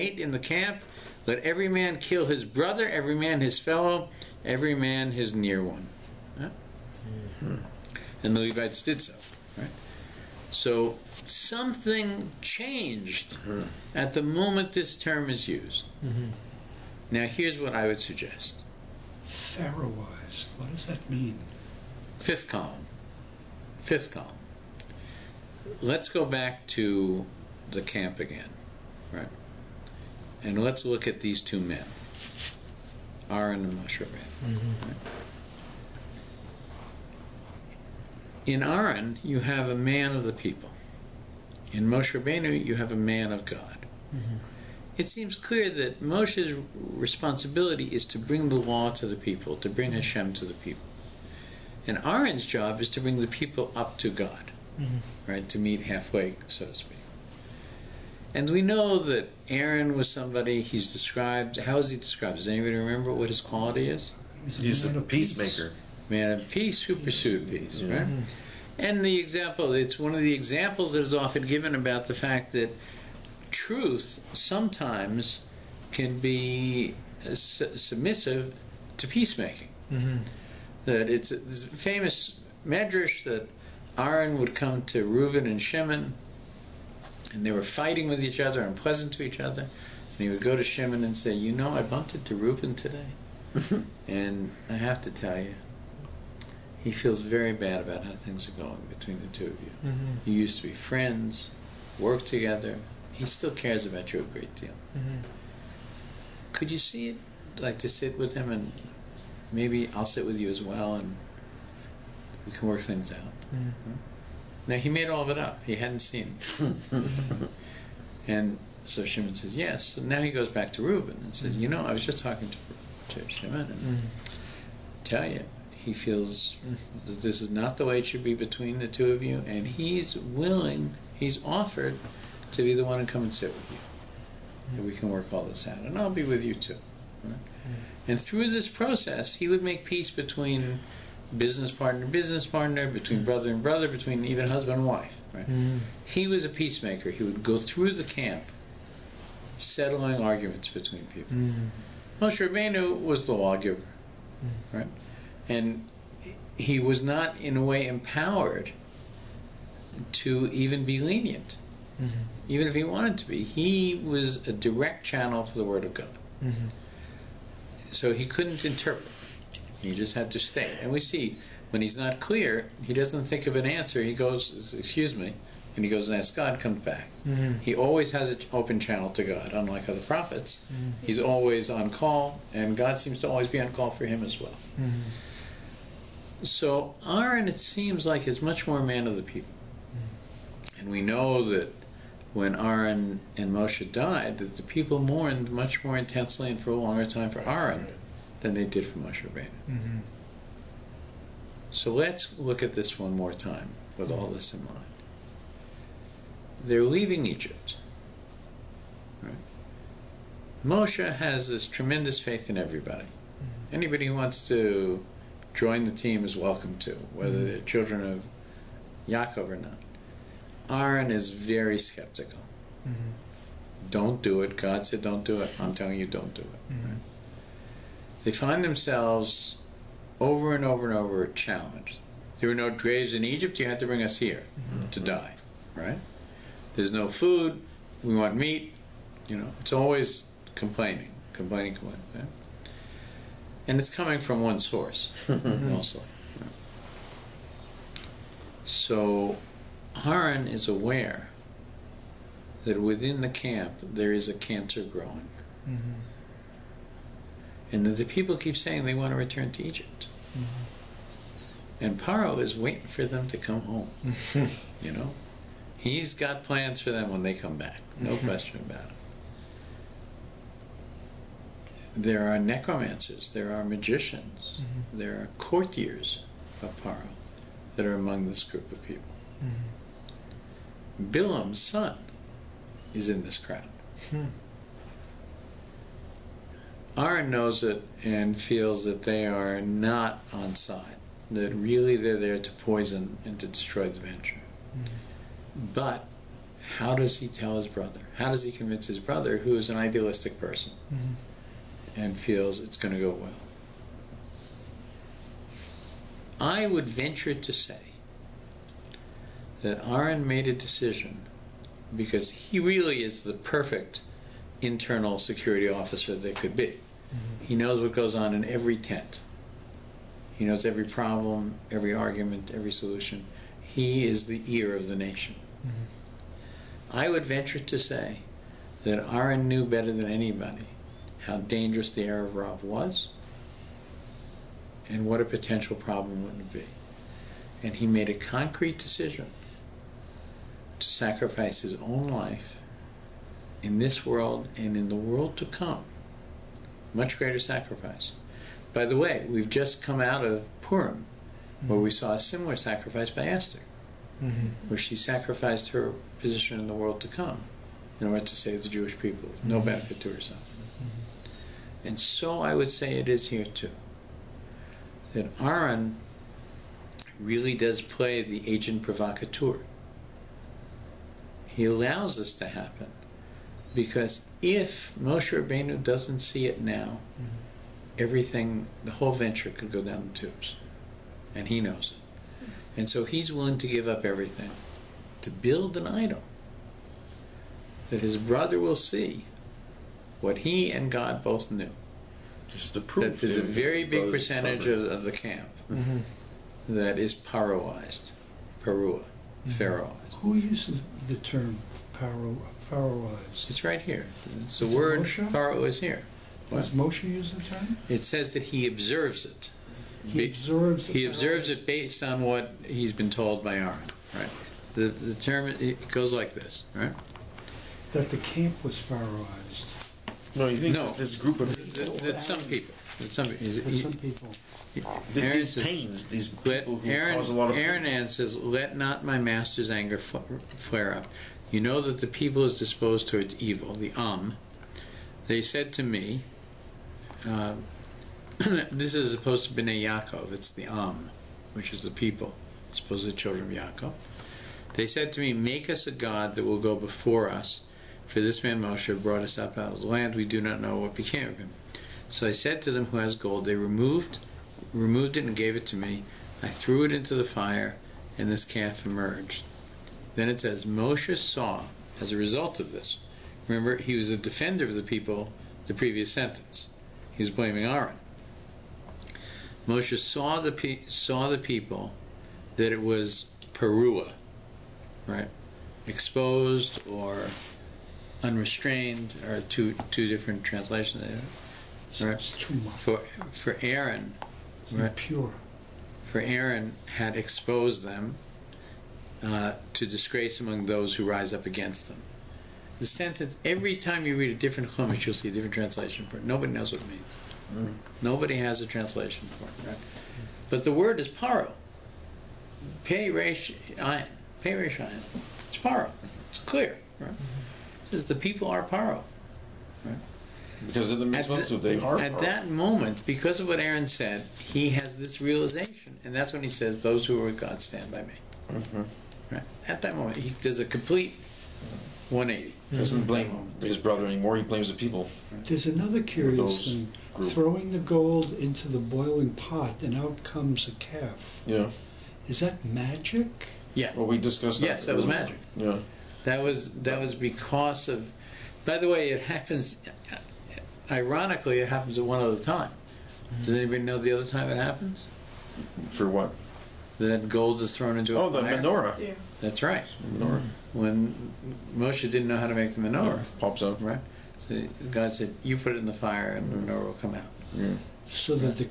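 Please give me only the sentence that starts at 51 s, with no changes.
And Aaron's job is to bring the people up to God, mm-hmm.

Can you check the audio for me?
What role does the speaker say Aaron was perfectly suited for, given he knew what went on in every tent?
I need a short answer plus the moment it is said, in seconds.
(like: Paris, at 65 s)
internal security officer, at 314 s.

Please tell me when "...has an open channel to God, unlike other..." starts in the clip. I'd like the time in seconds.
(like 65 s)
178 s.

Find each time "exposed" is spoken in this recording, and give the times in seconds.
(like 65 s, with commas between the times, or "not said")
475 s, 487 s.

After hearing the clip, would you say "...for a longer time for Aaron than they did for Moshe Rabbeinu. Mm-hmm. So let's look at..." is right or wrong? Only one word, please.
right.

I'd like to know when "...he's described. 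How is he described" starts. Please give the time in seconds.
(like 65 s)
60 s.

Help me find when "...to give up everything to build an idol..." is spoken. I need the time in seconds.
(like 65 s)
383 s.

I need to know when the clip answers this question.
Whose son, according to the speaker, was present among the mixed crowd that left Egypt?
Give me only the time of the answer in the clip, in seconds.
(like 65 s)
281 s.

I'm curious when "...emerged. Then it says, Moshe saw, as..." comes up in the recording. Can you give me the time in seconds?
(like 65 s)
458 s.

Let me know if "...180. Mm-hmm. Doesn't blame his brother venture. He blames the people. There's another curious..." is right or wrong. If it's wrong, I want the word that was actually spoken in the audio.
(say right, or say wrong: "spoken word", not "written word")
wrong: "anymore", not "venture".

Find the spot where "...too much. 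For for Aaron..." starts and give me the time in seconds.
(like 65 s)
482 s.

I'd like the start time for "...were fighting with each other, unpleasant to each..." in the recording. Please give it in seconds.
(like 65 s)
87 s.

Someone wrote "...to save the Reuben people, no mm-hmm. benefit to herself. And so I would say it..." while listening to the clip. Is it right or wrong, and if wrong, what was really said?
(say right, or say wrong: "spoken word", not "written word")
wrong: "Jewish", not "Reuben".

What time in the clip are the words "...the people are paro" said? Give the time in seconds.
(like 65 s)
508 s.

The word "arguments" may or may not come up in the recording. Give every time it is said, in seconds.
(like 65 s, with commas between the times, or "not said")
150 s, 321 s.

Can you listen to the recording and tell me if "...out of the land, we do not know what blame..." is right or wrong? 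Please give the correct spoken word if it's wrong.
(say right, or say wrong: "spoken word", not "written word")
wrong: "became", not "blame".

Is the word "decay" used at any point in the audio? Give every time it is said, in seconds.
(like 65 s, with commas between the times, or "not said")
not said.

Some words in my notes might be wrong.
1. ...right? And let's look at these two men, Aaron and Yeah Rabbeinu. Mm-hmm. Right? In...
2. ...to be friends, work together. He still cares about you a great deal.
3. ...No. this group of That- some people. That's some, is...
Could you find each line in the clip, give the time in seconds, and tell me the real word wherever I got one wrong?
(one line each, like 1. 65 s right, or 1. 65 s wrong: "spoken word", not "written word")
1. 29 s wrong: "Moshe", not "Yeah"
2. 100 s right
3. 420 s right.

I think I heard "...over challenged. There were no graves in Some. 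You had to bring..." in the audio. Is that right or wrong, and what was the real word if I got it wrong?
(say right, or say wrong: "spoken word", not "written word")
wrong: "Egypt", not "Some".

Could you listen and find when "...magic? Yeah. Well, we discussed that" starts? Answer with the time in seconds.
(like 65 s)
532 s.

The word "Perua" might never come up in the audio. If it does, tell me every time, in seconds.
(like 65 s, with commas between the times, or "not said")
398 s, 473 s.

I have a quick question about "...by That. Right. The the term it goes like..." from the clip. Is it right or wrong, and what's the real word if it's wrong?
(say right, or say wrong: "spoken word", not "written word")
wrong: "Aaron", not "That".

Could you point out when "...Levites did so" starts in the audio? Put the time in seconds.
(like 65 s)
8 s.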